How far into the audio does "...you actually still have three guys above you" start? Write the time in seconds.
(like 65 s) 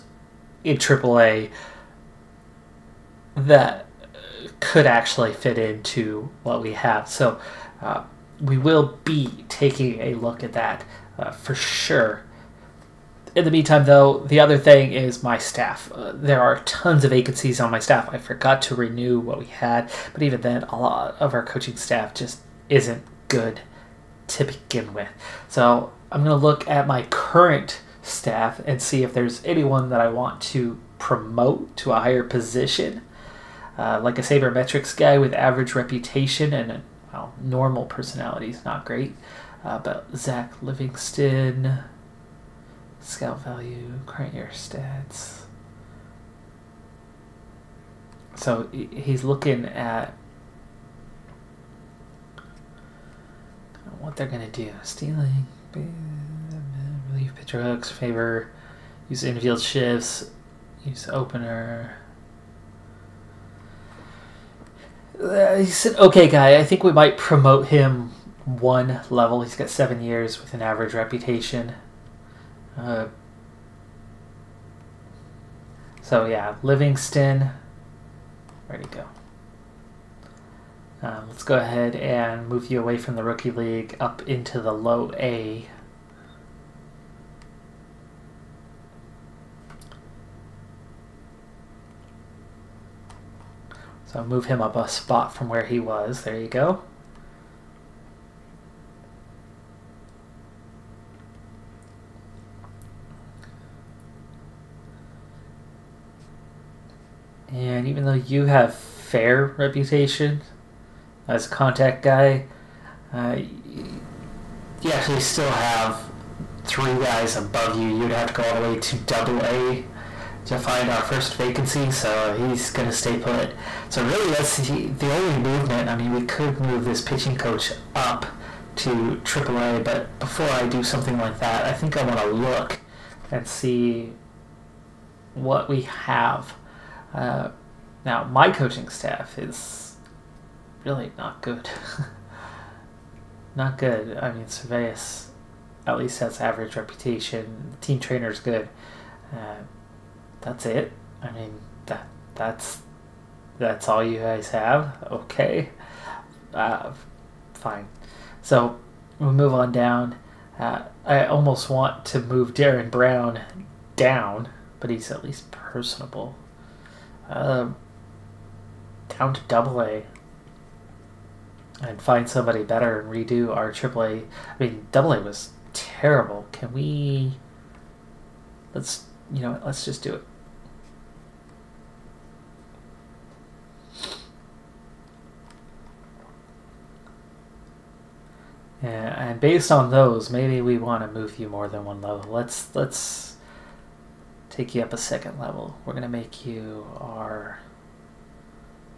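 114 s.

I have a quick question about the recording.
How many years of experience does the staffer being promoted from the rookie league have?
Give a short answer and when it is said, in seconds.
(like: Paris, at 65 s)
7, at 69 s.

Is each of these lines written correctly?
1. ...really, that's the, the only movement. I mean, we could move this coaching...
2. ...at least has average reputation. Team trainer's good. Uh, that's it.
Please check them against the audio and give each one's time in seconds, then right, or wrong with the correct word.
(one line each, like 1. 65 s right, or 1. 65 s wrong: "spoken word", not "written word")
1. 124 s wrong: "pitching", not "coaching"
2. 145 s right.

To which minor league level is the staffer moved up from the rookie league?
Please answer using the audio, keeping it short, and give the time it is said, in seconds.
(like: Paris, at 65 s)
Low A, at 84 s.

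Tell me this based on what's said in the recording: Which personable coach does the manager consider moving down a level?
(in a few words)
Darren Brown.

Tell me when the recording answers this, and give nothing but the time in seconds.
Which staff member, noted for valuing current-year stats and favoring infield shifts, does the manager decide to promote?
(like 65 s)
40 s.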